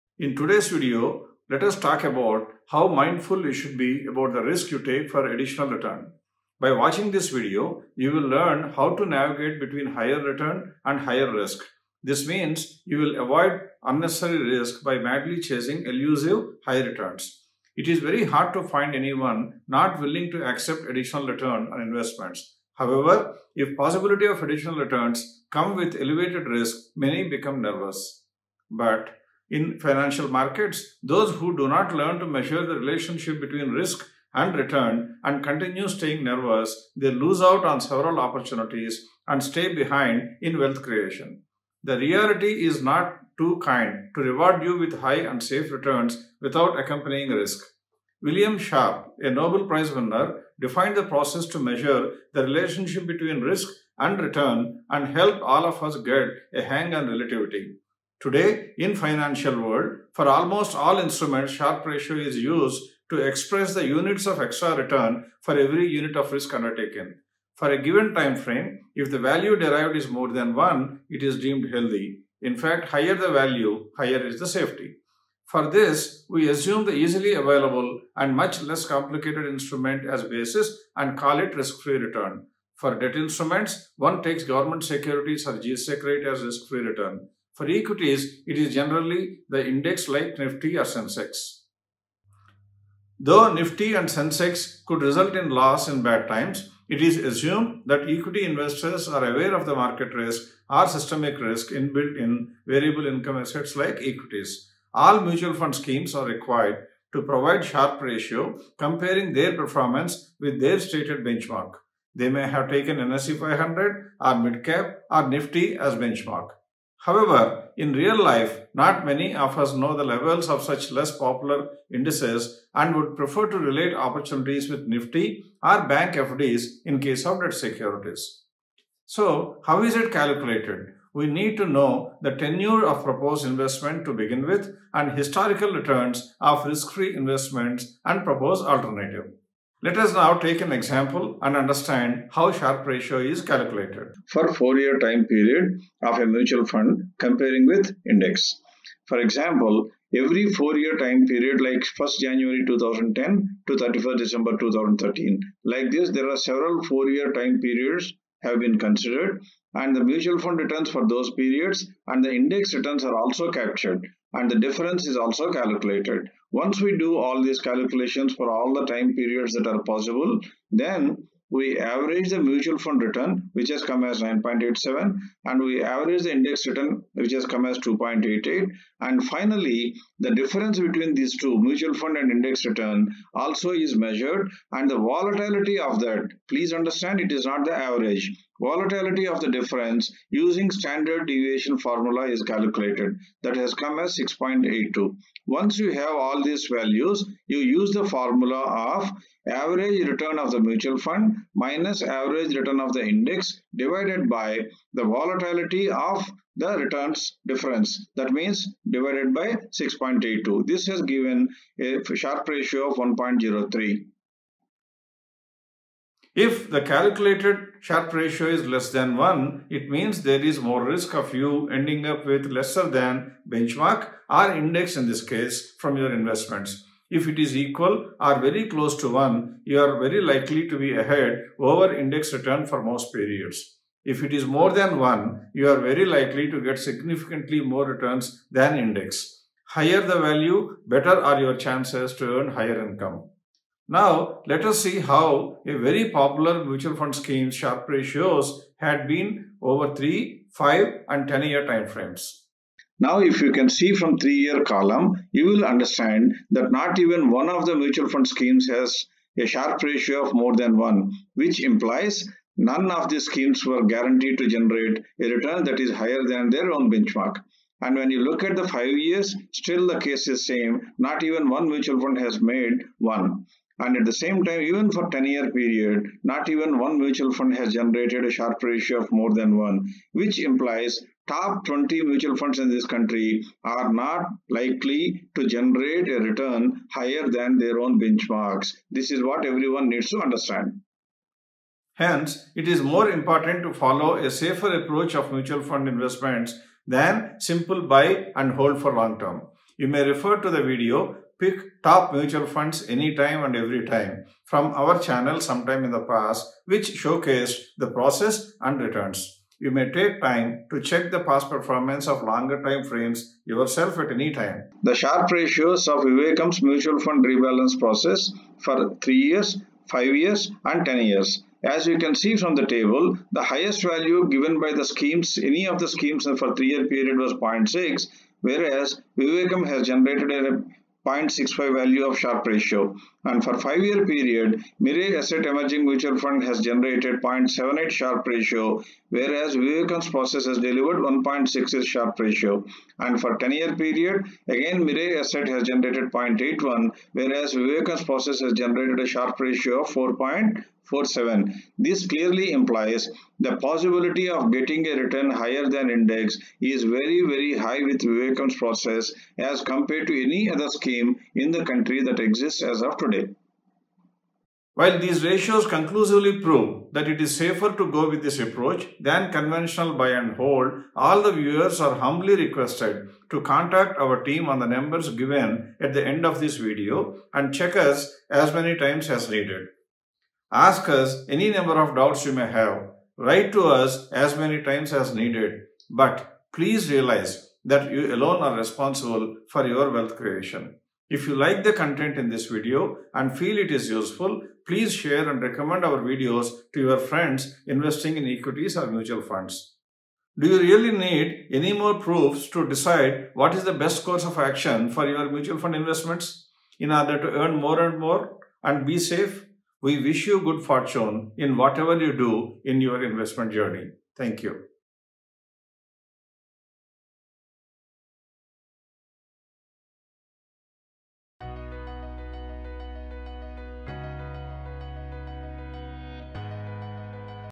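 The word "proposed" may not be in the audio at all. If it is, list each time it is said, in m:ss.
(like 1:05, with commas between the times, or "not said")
2:13, 2:18.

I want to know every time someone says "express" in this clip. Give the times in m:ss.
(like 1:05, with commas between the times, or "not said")
1:03.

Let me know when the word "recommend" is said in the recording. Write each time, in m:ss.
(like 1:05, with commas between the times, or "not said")
6:35.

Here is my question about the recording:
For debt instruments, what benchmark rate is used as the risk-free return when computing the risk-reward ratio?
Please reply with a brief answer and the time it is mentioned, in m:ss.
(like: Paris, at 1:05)
GSEC rate, at 1:25.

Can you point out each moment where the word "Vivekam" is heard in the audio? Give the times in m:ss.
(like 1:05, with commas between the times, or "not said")
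5:16, 5:29, 5:39, 5:47, 5:58.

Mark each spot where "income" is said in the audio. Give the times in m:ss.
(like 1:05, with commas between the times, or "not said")
1:43, 4:02.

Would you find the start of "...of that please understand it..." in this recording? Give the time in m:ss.
3:05.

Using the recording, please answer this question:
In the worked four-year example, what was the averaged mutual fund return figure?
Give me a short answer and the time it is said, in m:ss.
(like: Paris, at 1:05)
9.87, at 2:54.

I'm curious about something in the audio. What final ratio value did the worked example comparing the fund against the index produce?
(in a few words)
1.03.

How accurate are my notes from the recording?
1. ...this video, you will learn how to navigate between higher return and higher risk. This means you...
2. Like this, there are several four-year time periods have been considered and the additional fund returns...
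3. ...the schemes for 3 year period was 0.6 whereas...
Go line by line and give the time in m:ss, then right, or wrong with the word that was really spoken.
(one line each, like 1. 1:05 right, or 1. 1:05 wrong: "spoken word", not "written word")
1. 0:07 right
2. 2:35 wrong: "mutual", not "additional"
3. 5:25 right.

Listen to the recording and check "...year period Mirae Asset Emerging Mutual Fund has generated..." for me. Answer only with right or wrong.
right.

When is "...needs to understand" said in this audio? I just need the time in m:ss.
4:49.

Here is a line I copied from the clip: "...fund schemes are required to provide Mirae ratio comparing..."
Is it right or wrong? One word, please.
wrong.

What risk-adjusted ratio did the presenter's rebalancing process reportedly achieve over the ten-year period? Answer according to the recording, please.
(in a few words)
4.47.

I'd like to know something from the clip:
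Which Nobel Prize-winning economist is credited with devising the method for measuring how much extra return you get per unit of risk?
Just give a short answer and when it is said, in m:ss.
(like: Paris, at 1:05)
William Sharpe, at 0:48.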